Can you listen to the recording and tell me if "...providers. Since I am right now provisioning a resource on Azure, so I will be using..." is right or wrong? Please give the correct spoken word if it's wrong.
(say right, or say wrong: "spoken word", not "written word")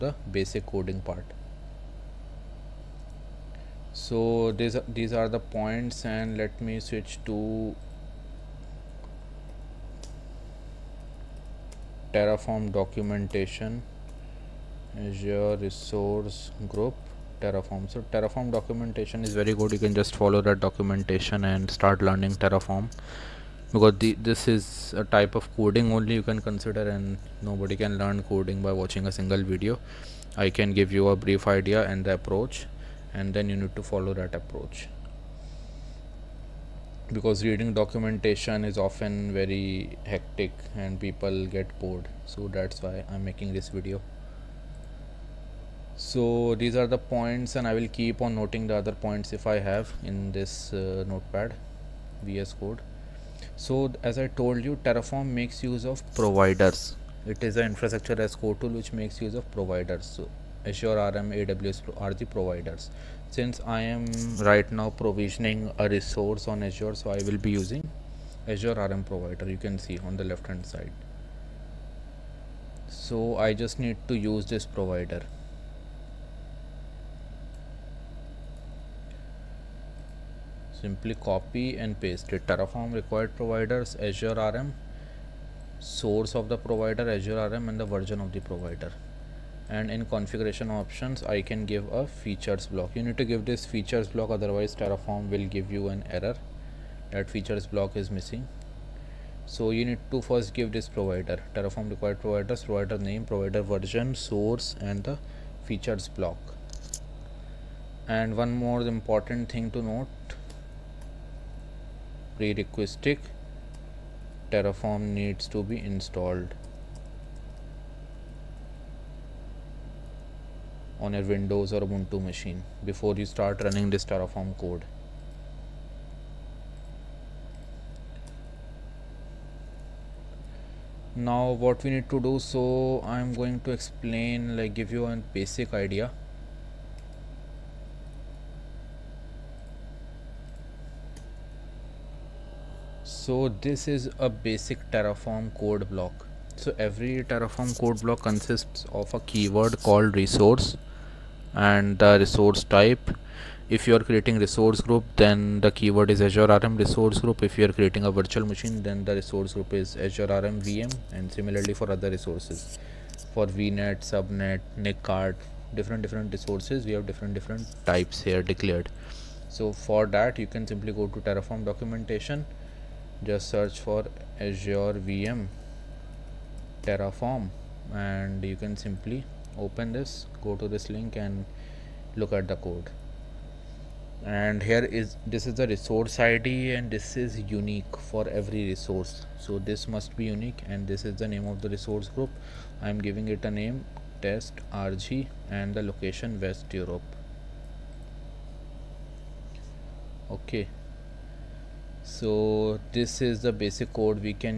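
right.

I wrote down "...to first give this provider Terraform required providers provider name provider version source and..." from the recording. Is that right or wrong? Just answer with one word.
right.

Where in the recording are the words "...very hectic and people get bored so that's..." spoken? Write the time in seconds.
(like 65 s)
39 s.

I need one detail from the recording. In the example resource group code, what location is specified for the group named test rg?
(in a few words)
West Europe.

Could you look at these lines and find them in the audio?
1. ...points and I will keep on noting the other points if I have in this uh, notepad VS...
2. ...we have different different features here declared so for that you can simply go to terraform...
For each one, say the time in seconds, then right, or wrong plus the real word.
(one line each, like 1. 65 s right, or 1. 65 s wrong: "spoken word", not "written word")
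1. 46 s right
2. 166 s wrong: "types", not "features".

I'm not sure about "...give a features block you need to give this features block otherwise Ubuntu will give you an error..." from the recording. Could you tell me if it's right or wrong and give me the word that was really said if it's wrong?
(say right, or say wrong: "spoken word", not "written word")
wrong: "Terraform", not "Ubuntu".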